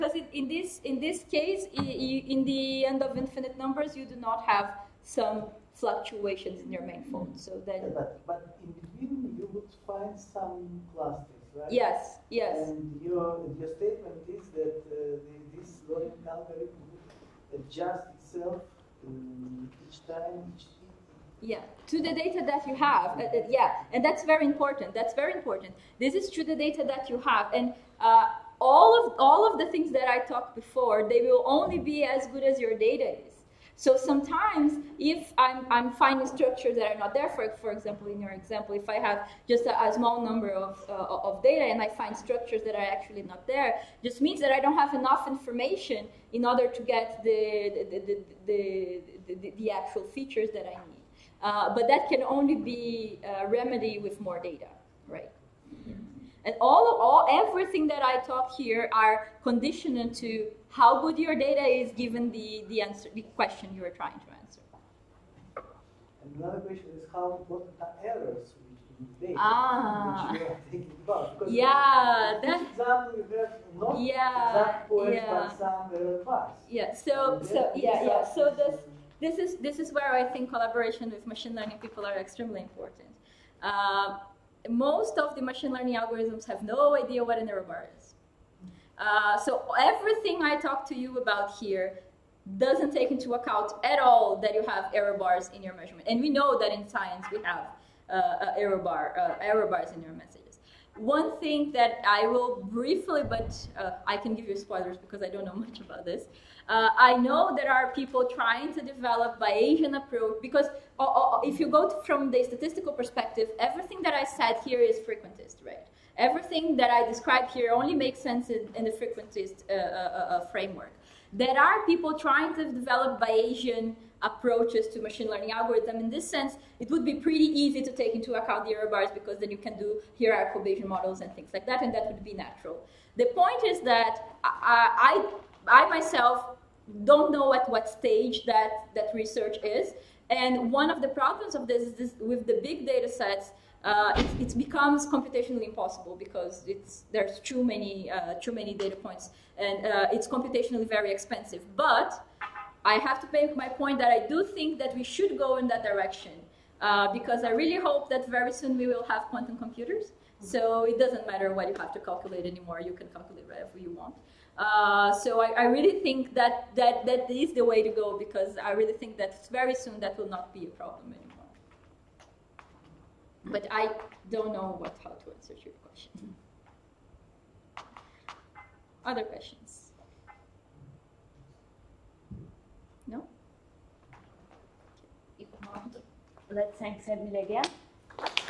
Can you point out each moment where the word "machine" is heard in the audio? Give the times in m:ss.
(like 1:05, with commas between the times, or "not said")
1:21, 1:25, 2:05.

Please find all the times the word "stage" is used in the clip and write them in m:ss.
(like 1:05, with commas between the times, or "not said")
2:17.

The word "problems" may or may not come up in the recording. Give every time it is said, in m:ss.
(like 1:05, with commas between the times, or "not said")
2:21, 2:50.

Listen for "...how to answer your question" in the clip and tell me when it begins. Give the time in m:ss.
2:55.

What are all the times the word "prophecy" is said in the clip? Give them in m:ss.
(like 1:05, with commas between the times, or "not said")
not said.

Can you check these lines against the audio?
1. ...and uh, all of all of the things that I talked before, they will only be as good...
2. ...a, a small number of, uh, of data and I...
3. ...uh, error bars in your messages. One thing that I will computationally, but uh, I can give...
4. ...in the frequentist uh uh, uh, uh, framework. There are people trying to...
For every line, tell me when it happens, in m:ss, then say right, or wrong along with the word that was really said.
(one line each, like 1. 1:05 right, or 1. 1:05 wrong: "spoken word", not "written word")
1. 0:27 right
2. 0:39 right
3. 1:39 wrong: "briefly", not "computationally"
4. 1:58 right.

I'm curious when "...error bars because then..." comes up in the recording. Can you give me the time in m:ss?
2:08.